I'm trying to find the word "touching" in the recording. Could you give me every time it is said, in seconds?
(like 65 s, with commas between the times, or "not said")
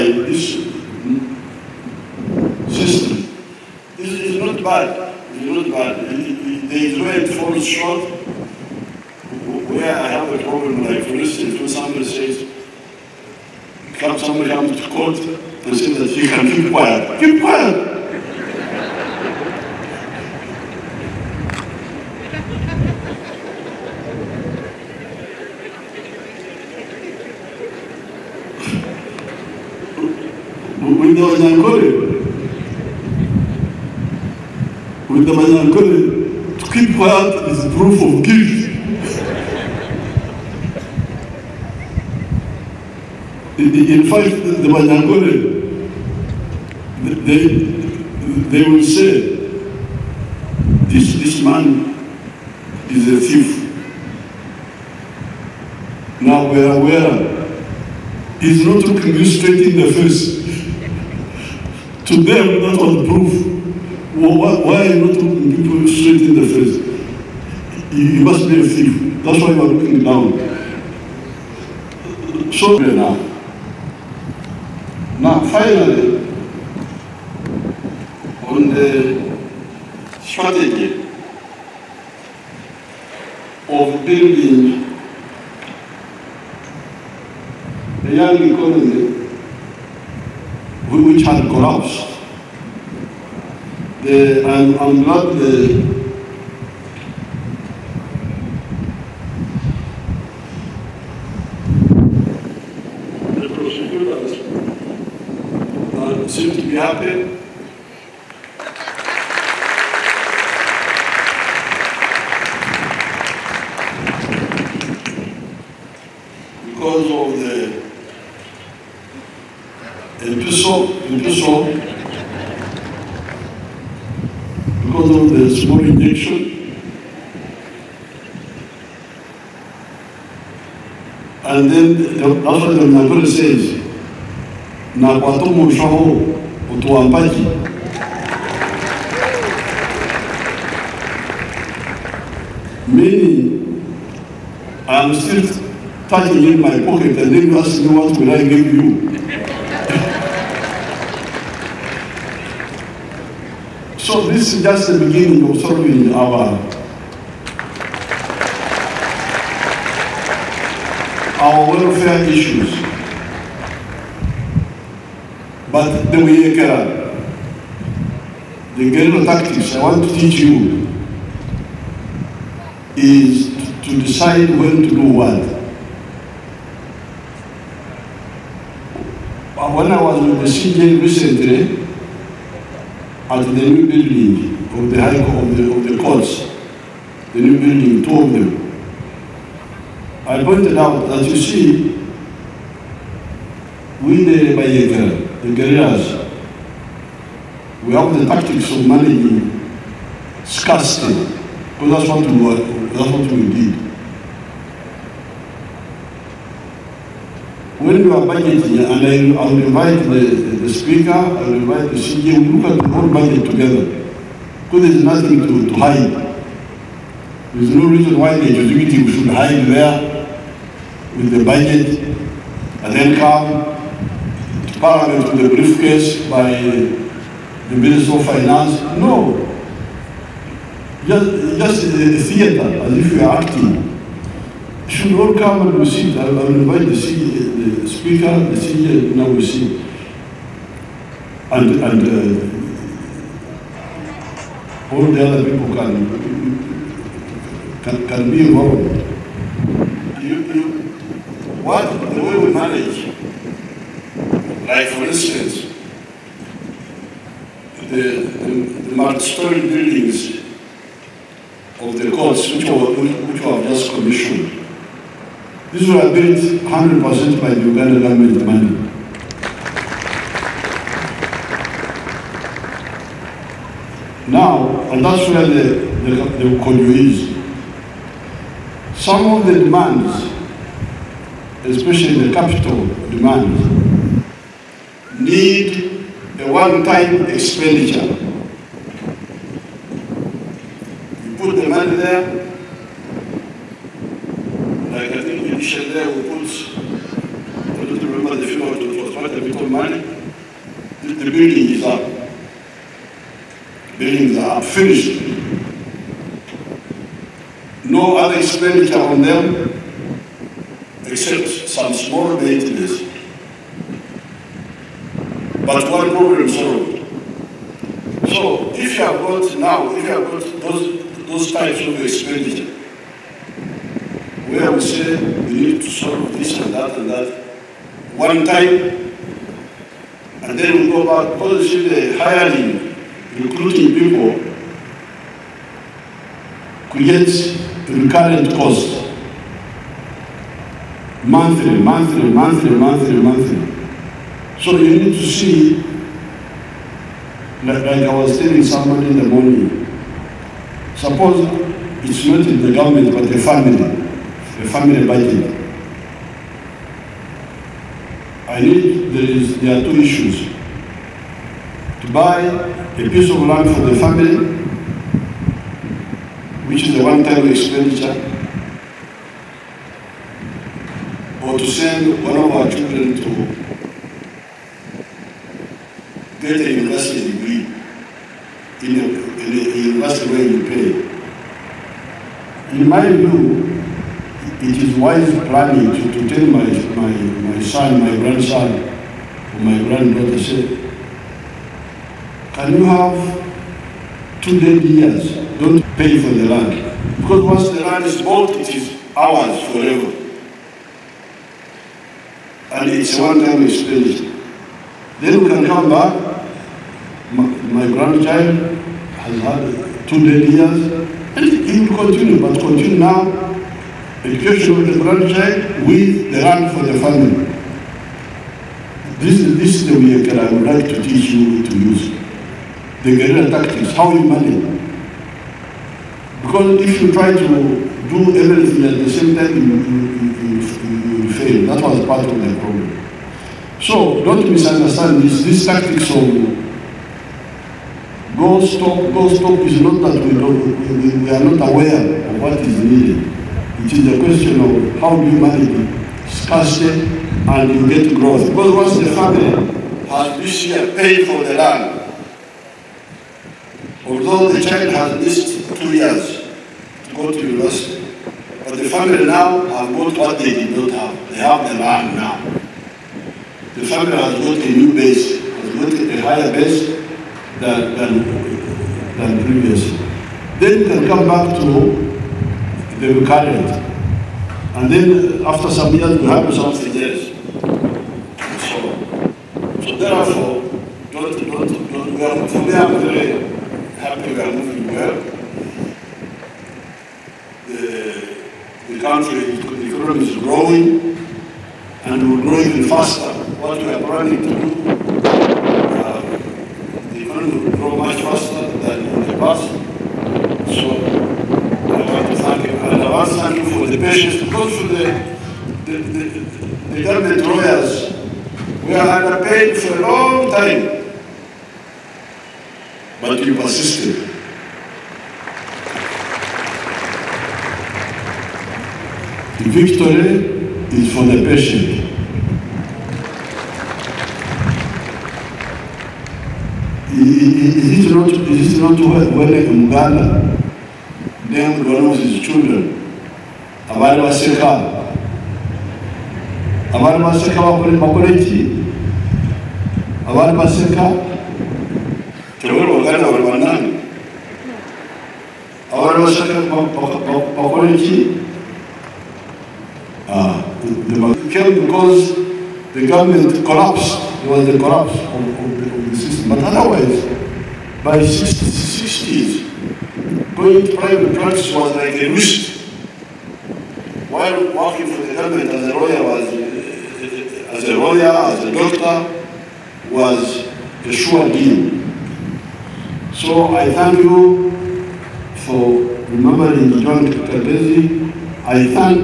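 146 s.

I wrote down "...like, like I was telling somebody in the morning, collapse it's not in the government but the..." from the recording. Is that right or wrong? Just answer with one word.
wrong.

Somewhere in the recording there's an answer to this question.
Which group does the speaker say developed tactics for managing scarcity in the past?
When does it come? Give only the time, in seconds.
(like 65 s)
194 s.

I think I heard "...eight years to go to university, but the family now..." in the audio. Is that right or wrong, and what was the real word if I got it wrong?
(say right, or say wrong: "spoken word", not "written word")
wrong: "two", not "eight".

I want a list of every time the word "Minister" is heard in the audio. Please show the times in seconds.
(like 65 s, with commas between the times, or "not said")
227 s.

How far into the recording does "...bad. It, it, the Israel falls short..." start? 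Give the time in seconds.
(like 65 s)
5 s.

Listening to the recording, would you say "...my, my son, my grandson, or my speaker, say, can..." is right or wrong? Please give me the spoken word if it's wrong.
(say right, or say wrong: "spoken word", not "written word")
wrong: "granddaughter", not "speaker".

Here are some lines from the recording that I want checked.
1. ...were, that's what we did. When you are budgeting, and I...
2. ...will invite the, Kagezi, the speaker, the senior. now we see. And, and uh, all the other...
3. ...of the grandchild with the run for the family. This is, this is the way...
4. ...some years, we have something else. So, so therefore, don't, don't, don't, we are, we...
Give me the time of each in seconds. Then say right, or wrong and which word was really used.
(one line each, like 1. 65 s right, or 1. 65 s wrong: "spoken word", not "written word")
1. 202 s right
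2. 236 s wrong: "CEO", not "Kagezi"
3. 414 s right
4. 475 s right.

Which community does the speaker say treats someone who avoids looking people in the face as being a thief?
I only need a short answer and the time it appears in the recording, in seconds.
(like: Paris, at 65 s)
Banyankore, at 44 s.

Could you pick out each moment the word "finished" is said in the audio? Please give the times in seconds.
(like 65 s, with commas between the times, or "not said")
304 s, 403 s.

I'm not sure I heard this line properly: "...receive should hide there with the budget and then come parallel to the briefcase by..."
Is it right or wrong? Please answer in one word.
wrong.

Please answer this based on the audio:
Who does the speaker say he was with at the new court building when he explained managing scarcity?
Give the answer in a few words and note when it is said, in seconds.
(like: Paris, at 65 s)
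the CJ, at 180 s.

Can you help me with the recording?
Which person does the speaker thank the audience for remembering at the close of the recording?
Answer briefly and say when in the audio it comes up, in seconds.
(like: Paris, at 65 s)
Joan Kagezi, at 577 s.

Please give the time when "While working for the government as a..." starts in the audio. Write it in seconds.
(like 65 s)
564 s.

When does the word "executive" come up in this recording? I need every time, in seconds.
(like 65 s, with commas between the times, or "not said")
218 s.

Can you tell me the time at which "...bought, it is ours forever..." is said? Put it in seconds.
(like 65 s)
398 s.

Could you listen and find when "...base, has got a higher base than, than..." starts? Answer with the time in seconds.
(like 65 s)
464 s.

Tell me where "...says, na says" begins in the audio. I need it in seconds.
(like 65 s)
133 s.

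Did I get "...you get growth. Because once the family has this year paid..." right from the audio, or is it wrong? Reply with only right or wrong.
right.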